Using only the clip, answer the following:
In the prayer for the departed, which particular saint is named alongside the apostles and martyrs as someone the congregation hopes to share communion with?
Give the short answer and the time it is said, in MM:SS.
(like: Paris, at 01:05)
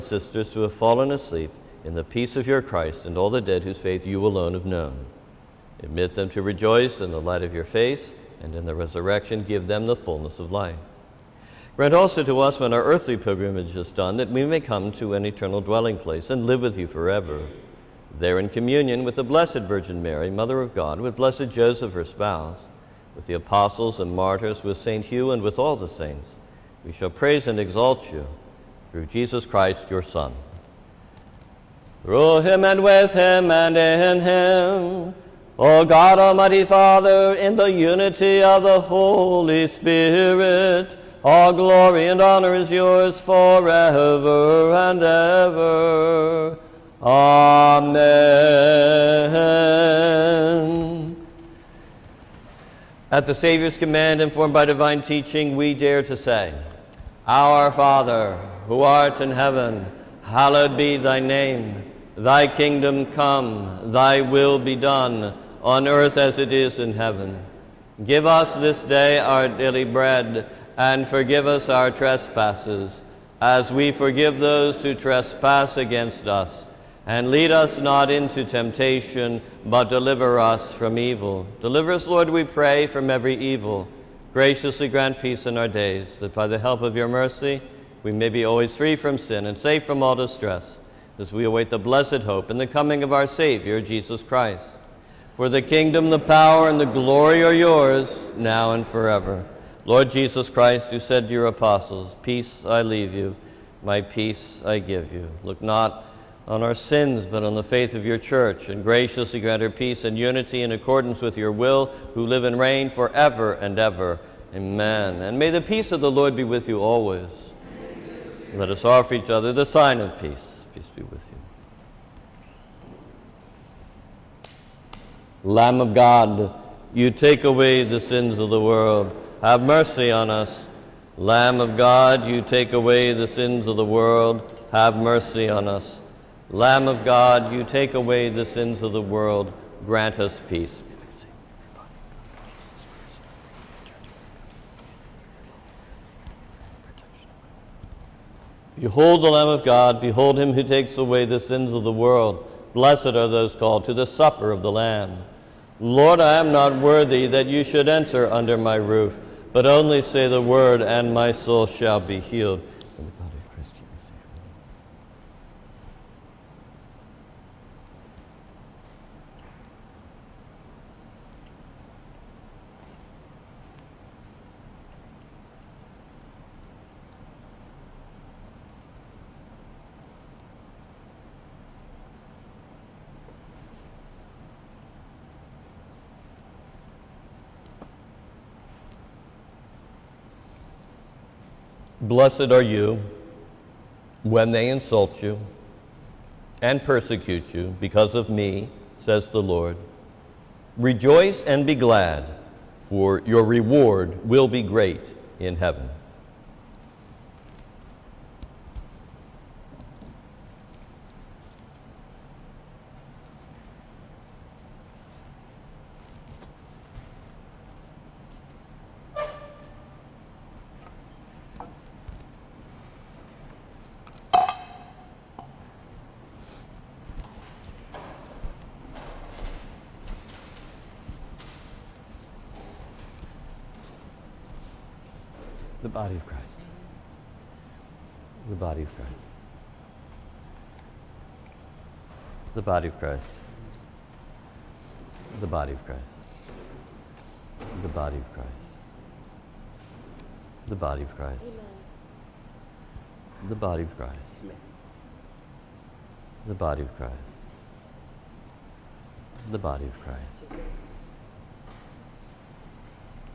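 St. Hugh, at 00:24.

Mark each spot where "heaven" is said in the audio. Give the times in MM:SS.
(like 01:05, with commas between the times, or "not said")
00:59, 01:06, 03:25.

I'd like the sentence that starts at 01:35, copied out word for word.
For the kingdom, the power, and the glory are yours, now and forever.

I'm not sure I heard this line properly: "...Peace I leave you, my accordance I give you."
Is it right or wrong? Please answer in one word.
wrong.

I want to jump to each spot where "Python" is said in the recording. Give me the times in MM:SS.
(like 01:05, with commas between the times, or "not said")
not said.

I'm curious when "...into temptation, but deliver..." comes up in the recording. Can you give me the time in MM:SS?
01:18.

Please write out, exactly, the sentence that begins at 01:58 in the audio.
Let us offer each other the sign of peace peace be with you.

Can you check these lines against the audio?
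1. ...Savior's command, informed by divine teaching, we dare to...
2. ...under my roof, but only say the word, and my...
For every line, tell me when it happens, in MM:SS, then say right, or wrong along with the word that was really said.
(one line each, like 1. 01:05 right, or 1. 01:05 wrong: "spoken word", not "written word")
1. 00:53 right
2. 02:38 right.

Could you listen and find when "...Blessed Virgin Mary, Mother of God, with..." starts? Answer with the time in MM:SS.
00:19.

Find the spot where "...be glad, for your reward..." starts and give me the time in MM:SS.
03:21.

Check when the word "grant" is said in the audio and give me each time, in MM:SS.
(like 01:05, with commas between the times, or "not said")
00:11, 01:24, 01:49, 02:19.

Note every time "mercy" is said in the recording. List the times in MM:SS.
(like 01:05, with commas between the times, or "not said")
01:27, 02:09, 02:14.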